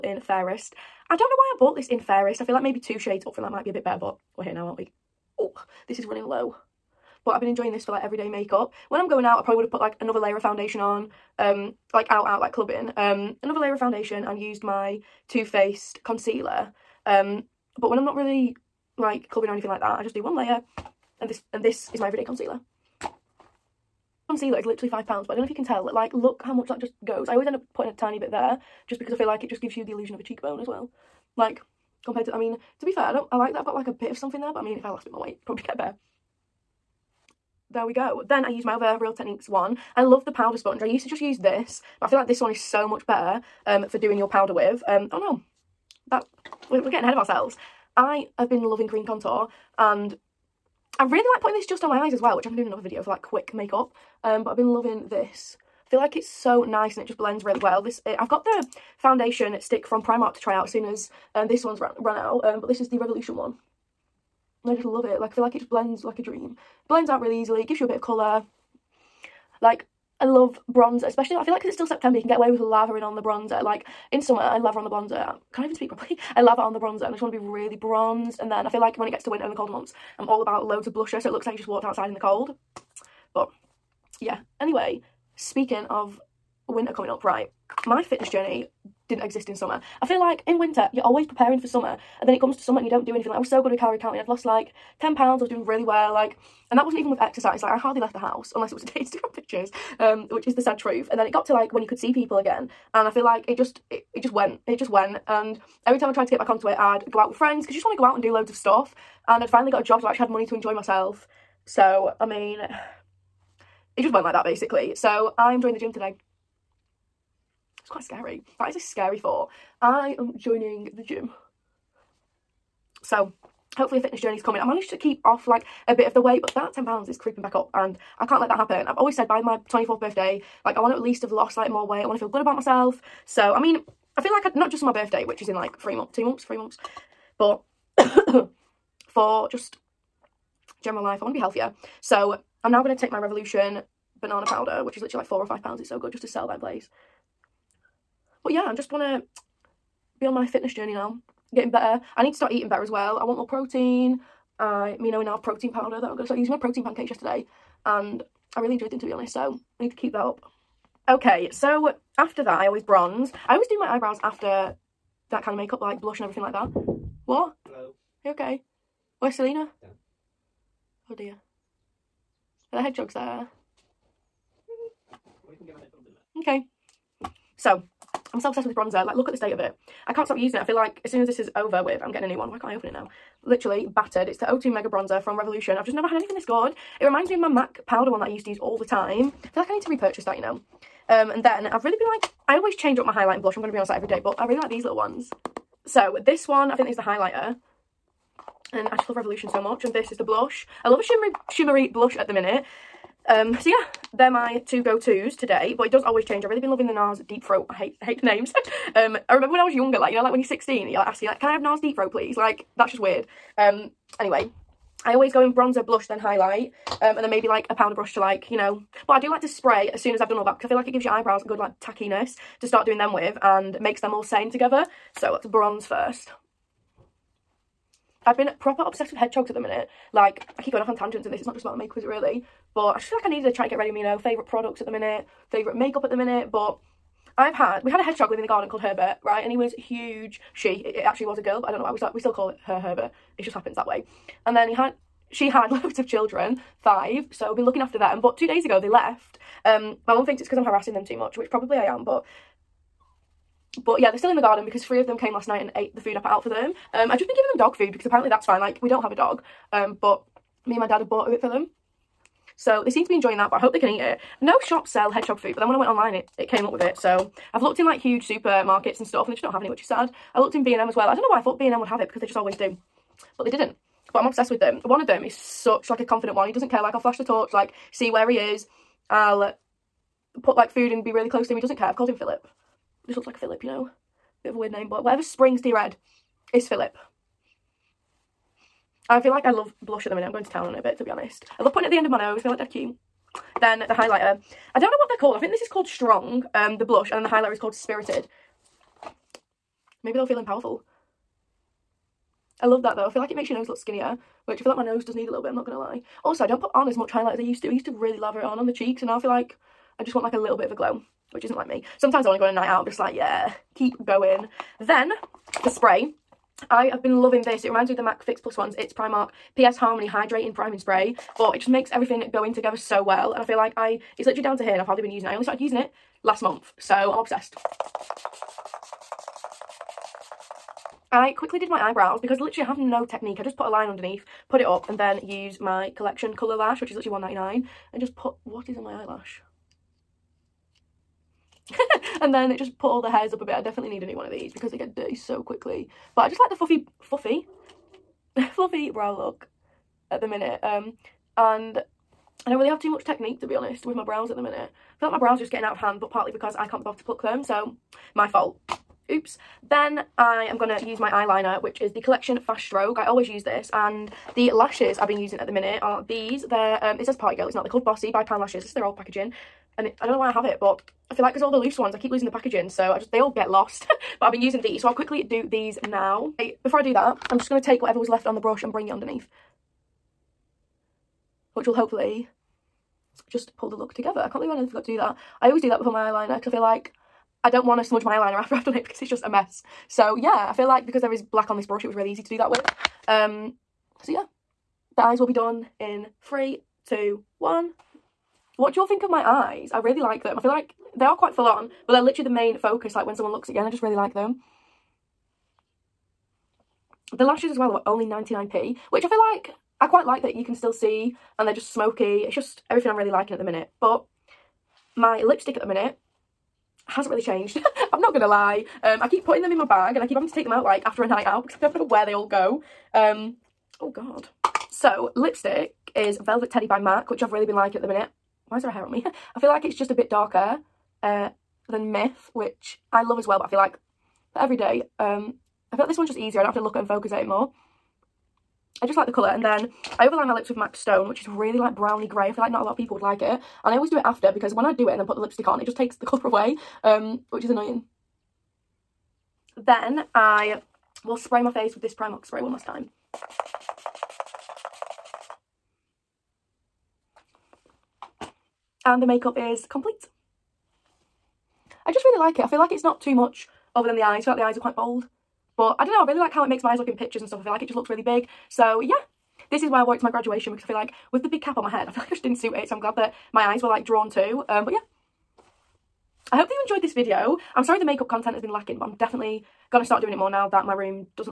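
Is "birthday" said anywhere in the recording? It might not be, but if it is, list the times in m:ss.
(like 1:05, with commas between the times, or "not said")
2:10, 2:14.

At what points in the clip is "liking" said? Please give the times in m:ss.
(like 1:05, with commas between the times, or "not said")
6:53, 7:07.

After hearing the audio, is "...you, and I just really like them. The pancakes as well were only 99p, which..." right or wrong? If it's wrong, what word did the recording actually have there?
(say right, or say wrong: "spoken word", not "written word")
wrong: "lashes", not "pancakes".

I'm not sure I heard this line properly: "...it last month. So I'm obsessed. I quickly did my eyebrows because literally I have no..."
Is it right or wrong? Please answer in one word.
right.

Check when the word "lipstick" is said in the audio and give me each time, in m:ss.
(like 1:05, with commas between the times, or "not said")
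6:55, 7:05, 7:25.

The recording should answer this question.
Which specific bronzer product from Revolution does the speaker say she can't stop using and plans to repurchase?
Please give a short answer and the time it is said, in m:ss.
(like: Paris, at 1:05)
O2 Mega Bronzer, at 3:04.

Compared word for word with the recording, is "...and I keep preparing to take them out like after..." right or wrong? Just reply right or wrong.
wrong.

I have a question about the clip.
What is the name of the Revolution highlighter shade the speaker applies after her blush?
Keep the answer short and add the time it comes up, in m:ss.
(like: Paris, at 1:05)
Spirited, at 4:57.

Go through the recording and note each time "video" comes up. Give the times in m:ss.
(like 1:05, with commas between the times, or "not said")
0:52, 7:56.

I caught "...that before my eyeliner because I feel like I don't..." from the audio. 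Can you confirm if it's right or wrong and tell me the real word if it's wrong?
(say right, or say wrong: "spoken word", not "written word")
right.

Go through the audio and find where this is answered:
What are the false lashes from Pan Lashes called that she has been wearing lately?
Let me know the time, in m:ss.
6:07.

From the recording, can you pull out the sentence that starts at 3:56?
But I've had, we had a hedgehog living in the garden called Herbert, right?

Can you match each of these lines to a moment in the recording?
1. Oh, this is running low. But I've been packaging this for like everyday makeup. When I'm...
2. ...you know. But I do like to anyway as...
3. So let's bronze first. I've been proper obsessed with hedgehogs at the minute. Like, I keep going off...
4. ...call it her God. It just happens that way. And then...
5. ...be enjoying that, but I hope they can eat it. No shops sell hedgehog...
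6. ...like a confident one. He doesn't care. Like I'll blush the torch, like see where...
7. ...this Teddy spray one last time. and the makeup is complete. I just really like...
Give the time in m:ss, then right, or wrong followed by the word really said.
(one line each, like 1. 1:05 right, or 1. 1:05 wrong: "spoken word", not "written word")
1. 0:05 wrong: "enjoying", not "packaging"
2. 3:38 wrong: "spray", not "anyway"
3. 3:45 right
4. 4:02 wrong: "Herbert", not "God"
5. 4:23 right
6. 4:35 wrong: "flash", not "blush"
7. 7:31 wrong: "Primark", not "Teddy".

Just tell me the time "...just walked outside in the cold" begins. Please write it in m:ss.
1:21.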